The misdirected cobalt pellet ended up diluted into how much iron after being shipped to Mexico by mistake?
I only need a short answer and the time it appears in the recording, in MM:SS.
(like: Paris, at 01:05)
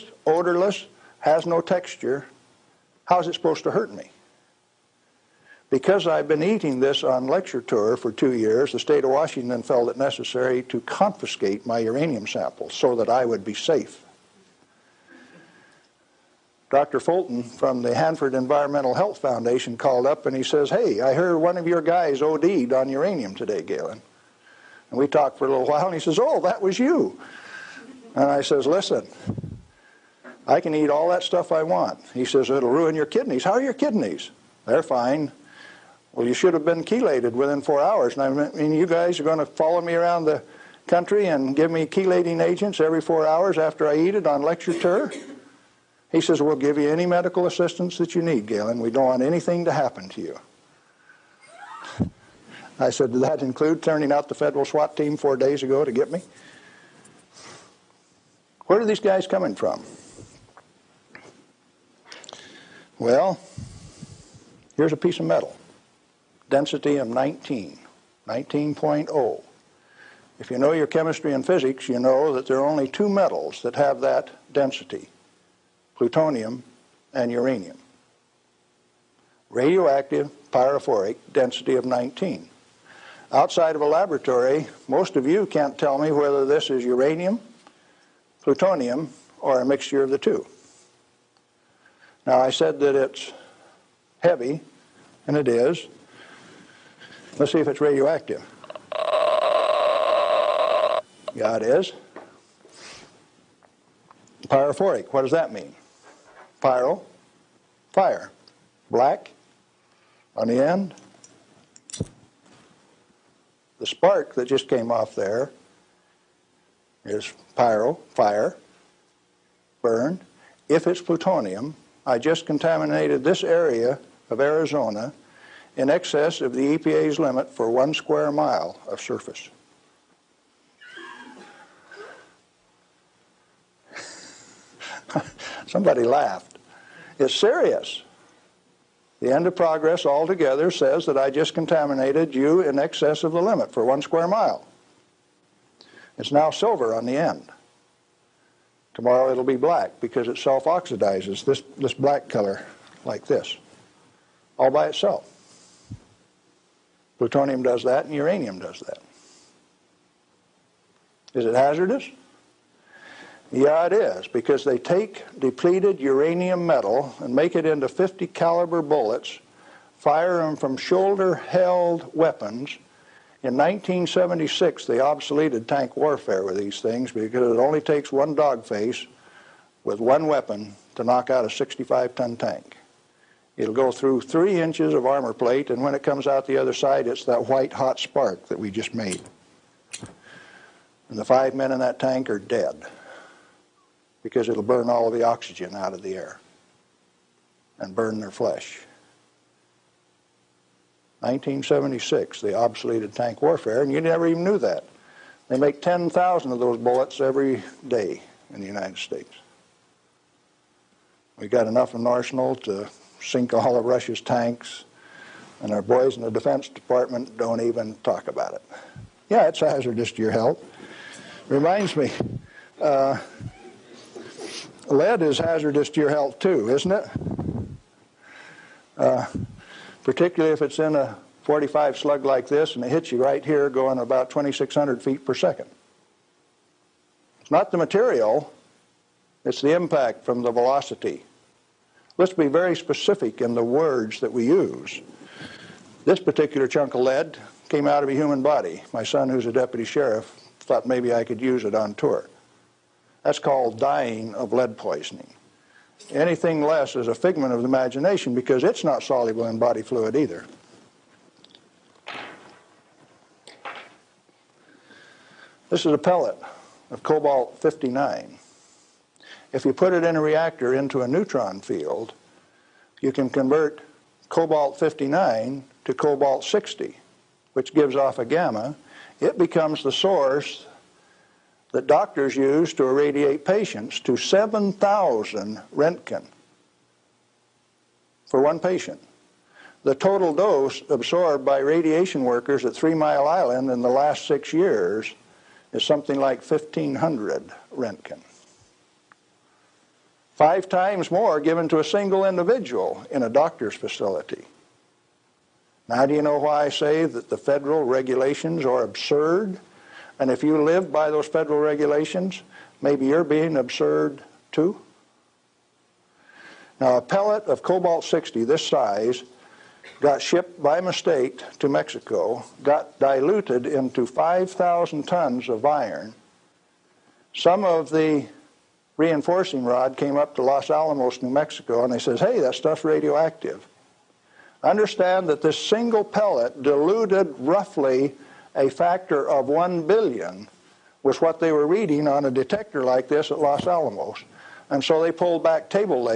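5,000 tons, at 05:24.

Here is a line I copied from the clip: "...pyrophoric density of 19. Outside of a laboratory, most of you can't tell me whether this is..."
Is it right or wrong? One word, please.
right.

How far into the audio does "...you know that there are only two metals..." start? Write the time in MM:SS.
01:11.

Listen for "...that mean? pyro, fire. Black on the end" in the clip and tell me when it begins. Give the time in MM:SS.
01:45.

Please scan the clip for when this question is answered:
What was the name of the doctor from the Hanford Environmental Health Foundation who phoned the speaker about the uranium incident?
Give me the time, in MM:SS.
00:16.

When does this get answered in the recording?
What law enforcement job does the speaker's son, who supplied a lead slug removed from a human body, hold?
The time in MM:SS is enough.
04:09.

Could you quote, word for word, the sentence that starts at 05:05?
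Now, do you know why I say that the federal regulations are absurd?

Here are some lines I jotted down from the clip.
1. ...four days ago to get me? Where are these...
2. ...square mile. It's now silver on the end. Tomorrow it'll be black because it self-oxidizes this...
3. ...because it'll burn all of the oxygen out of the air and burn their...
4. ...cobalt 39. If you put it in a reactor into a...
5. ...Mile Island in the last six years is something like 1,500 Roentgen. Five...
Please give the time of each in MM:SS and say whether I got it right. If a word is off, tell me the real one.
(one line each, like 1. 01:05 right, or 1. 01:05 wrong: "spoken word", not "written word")
1. 00:55 right
2. 02:24 right
3. 03:14 right
4. 04:27 wrong: "59", not "39"
5. 04:52 right.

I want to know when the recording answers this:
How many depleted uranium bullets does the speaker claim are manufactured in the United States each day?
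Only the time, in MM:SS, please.
03:25.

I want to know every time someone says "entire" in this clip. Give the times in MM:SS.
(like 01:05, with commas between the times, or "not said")
not said.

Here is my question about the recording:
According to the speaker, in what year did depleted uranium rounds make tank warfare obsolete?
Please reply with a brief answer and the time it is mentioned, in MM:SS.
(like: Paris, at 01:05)
1976, at 02:53.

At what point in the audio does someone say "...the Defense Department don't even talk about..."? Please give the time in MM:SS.
03:36.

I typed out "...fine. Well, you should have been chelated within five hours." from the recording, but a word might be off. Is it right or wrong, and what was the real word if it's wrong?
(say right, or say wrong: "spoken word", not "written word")
wrong: "four", not "five".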